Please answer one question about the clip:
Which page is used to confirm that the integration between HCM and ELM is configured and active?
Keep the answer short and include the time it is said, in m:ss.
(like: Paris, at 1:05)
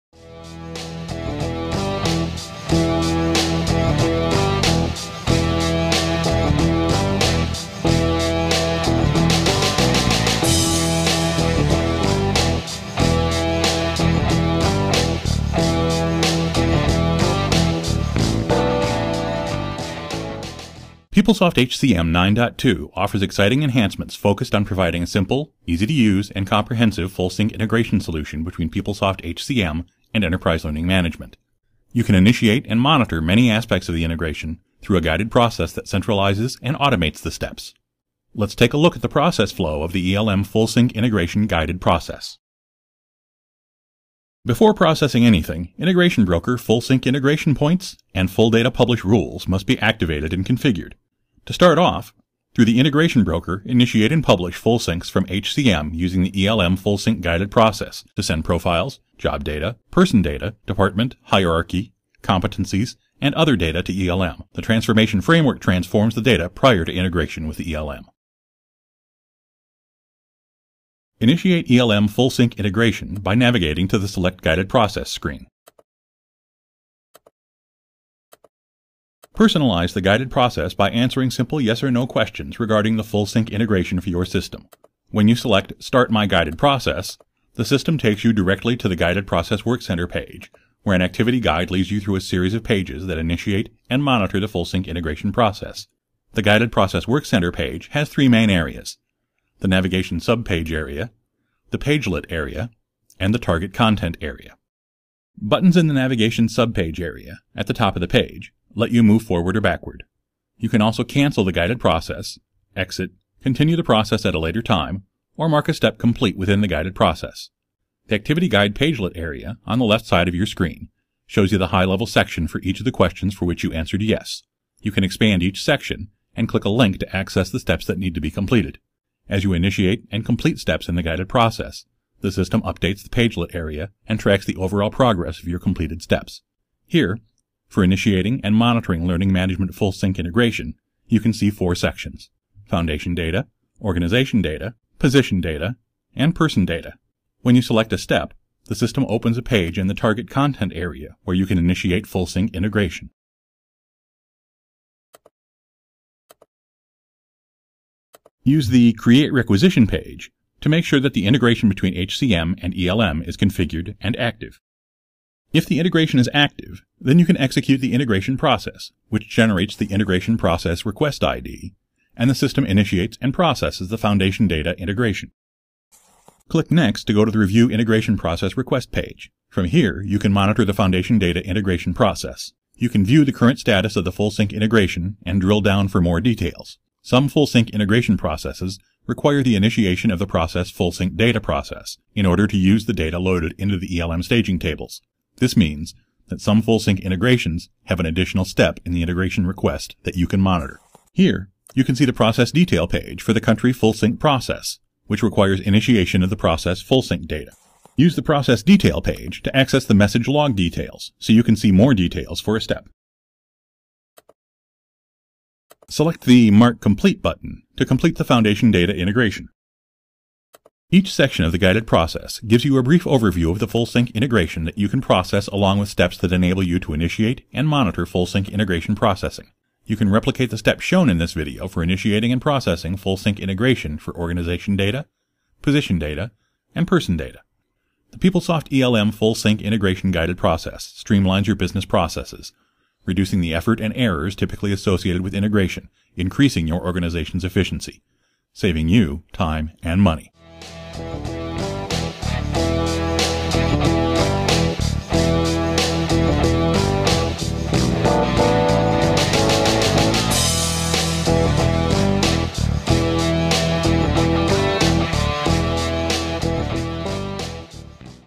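Create Requisition, at 2:38.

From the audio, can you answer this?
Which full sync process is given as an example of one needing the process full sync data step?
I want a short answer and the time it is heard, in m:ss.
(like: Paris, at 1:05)
Country, at 3:23.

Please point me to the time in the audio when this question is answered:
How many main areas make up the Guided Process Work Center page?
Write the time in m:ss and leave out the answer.
1:38.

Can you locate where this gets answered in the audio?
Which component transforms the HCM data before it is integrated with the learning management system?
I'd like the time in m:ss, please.
1:04.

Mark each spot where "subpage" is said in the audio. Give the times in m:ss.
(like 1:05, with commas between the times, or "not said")
1:40, 1:46.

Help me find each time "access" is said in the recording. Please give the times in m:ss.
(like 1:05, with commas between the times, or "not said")
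2:07, 3:29.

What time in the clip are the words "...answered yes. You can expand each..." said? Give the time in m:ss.
2:03.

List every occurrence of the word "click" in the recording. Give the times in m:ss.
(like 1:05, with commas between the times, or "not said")
2:06, 2:56.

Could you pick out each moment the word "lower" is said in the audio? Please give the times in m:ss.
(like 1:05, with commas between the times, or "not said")
not said.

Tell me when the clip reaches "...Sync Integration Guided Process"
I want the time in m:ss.
0:40.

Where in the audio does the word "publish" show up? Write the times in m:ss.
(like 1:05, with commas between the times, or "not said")
0:48, 0:54.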